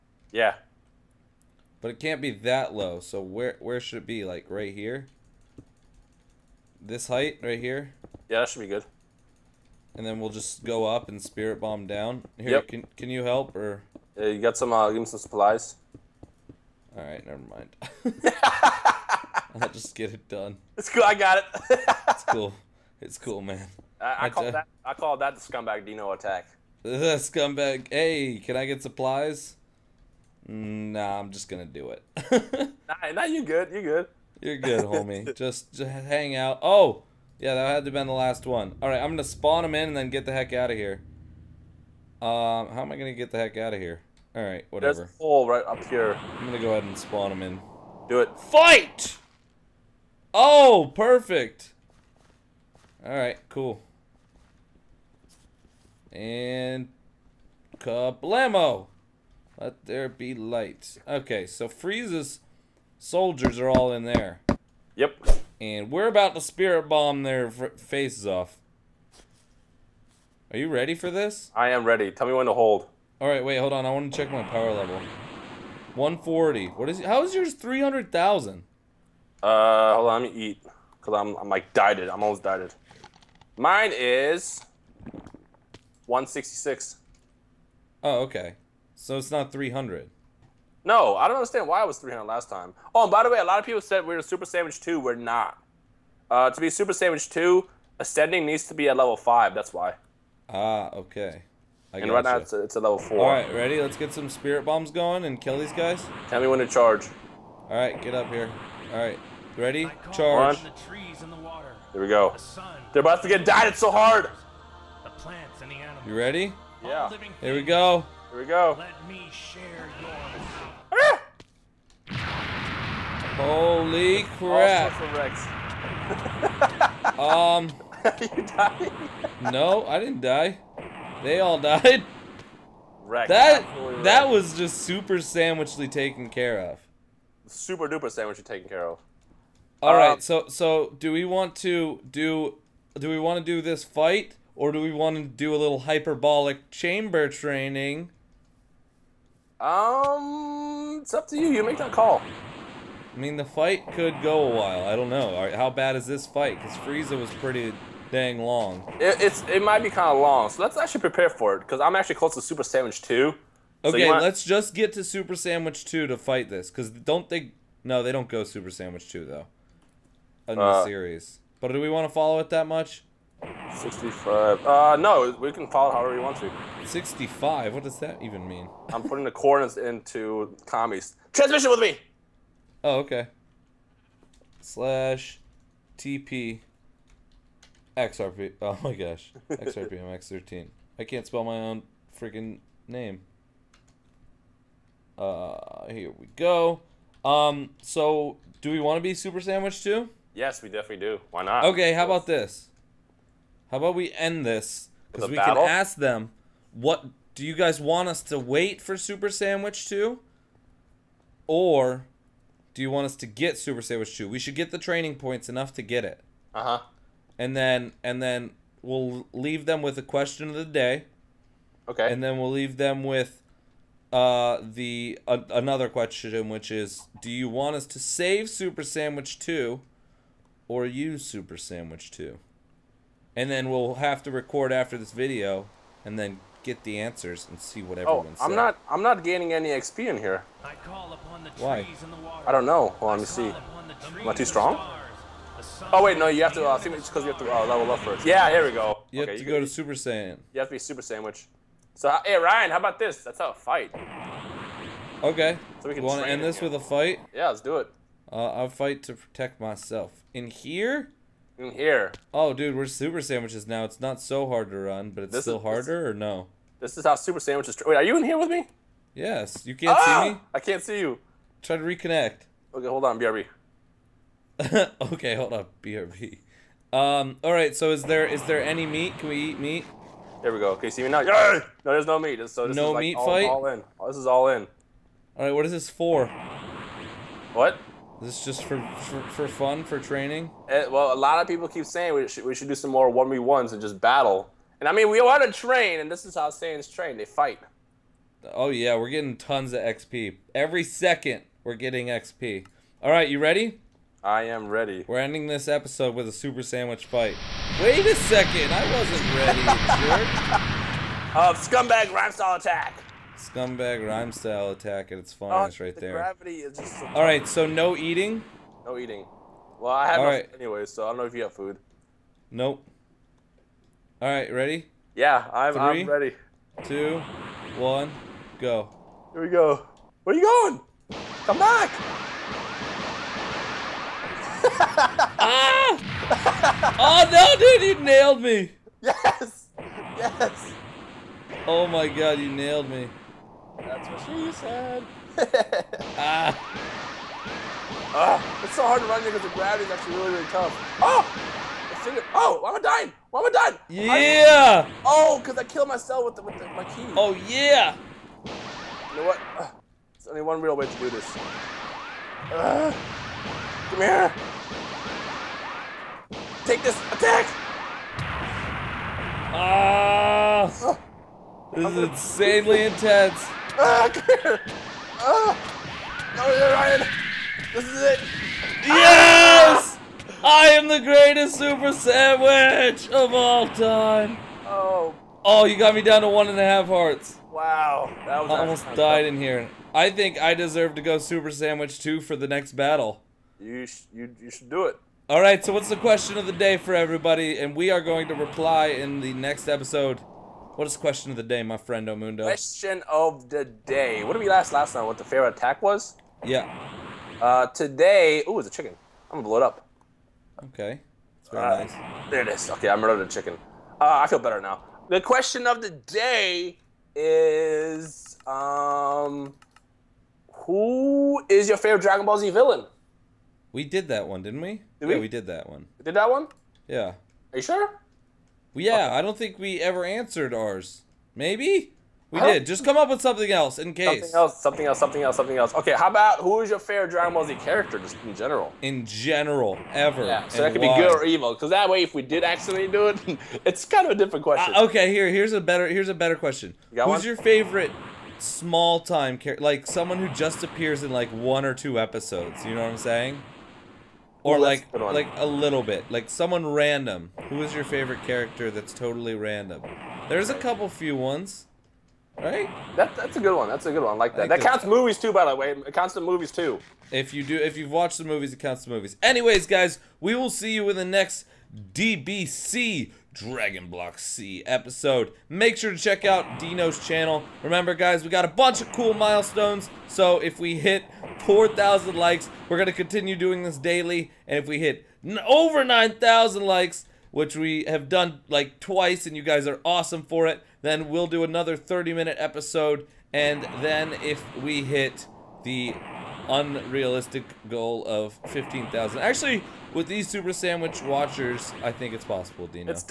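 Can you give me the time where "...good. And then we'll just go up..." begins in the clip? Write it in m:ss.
0:08.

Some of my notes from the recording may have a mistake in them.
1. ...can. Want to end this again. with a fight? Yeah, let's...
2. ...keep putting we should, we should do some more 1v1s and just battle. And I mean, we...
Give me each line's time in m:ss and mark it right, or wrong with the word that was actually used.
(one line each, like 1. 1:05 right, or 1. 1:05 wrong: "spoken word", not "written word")
1. 4:15 right
2. 4:51 wrong: "saying", not "putting".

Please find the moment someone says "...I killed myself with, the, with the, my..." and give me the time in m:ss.
5:55.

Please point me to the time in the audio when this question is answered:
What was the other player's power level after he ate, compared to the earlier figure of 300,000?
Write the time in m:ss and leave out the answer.
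1:26.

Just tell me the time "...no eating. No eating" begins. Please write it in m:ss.
5:17.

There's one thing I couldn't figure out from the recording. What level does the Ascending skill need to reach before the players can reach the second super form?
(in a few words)
level 5.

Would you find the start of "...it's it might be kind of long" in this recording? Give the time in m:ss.
2:39.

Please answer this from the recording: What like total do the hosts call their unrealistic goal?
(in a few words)
15,000.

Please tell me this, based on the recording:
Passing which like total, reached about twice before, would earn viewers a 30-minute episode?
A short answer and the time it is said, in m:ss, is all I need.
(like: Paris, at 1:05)
over 9,000, at 8:05.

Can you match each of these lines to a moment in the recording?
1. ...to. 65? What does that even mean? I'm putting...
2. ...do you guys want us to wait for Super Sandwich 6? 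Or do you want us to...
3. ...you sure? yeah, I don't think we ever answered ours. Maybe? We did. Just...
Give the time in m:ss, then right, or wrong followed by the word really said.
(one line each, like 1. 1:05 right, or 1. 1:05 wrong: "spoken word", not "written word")
1. 2:56 right
2. 3:27 wrong: "2", not "6"
3. 7:07 right.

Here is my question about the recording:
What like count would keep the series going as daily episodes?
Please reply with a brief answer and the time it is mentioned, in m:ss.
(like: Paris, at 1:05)
4,000, at 8:01.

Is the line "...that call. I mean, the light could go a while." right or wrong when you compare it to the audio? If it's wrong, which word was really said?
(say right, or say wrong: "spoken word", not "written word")
wrong: "fight", not "light".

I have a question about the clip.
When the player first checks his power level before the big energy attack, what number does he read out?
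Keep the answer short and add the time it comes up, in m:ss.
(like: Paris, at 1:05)
140, at 1:15.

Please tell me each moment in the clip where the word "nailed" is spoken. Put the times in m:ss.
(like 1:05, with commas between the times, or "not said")
5:38, 5:42.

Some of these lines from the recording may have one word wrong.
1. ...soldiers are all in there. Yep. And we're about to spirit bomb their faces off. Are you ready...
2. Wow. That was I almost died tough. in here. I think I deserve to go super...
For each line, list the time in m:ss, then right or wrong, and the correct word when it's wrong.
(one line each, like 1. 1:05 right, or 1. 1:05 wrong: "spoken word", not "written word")
1. 1:02 right
2. 6:27 right.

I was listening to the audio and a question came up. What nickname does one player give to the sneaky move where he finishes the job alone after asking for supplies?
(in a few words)
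scumbag Dino attack.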